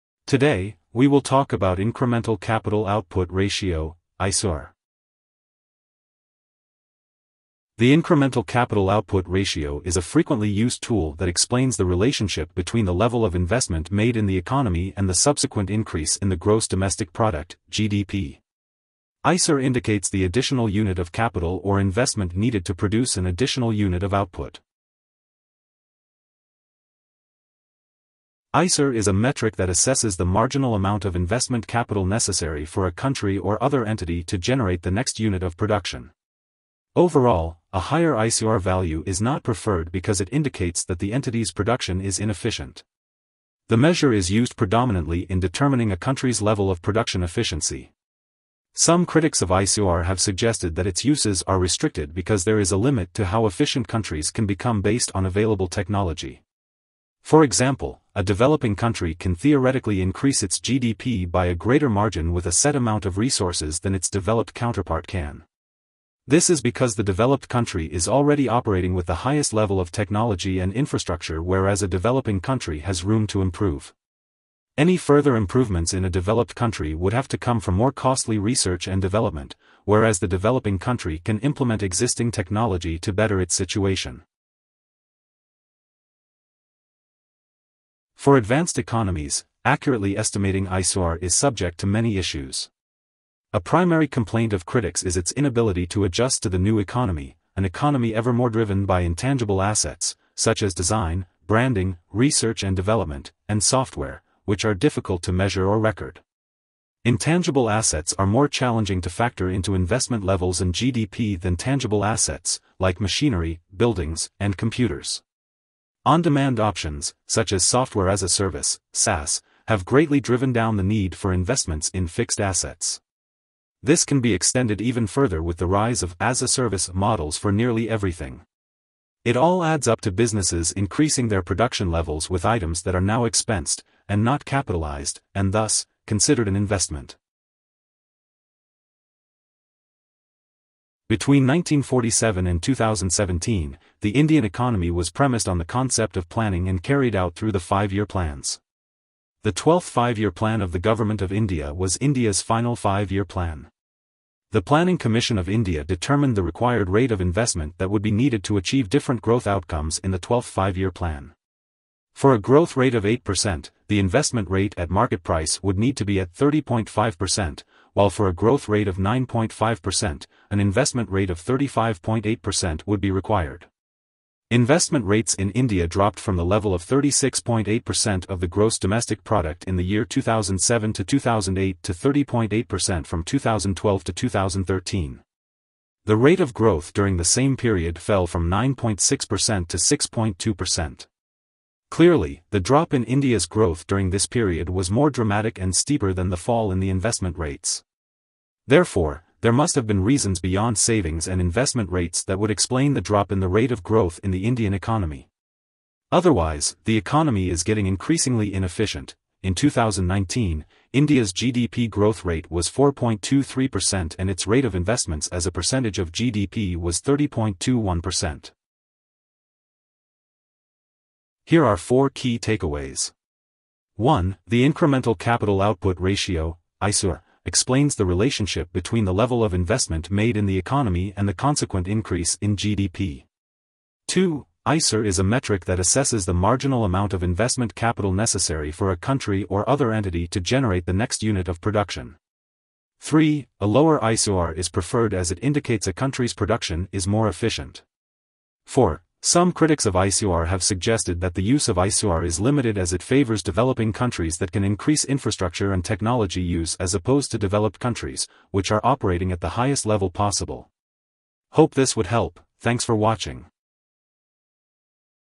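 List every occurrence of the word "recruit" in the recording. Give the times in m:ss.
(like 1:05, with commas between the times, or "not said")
not said.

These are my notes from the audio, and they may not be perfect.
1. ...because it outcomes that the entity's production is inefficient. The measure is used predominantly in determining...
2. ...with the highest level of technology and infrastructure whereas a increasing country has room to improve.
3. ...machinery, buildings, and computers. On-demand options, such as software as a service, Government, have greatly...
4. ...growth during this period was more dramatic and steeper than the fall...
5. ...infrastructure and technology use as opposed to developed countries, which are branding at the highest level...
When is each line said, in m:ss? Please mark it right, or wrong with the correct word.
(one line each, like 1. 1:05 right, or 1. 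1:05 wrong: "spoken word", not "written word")
1. 0:39 wrong: "indicates", not "outcomes"
2. 1:08 wrong: "developing", not "increasing"
3. 1:53 wrong: "SaaS", not "Government"
4. 3:13 right
5. 4:15 wrong: "operating", not "branding".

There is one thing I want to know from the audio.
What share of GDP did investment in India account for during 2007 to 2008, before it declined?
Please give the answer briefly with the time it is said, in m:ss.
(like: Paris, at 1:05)
36.8%, at 2:56.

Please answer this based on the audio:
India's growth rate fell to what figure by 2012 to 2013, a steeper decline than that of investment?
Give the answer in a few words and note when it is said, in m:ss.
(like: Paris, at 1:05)
6.2%, at 3:09.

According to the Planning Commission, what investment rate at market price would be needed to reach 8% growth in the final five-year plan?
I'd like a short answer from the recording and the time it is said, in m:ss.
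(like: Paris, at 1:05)
30.5%, at 2:46.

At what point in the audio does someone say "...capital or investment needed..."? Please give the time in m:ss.
0:21.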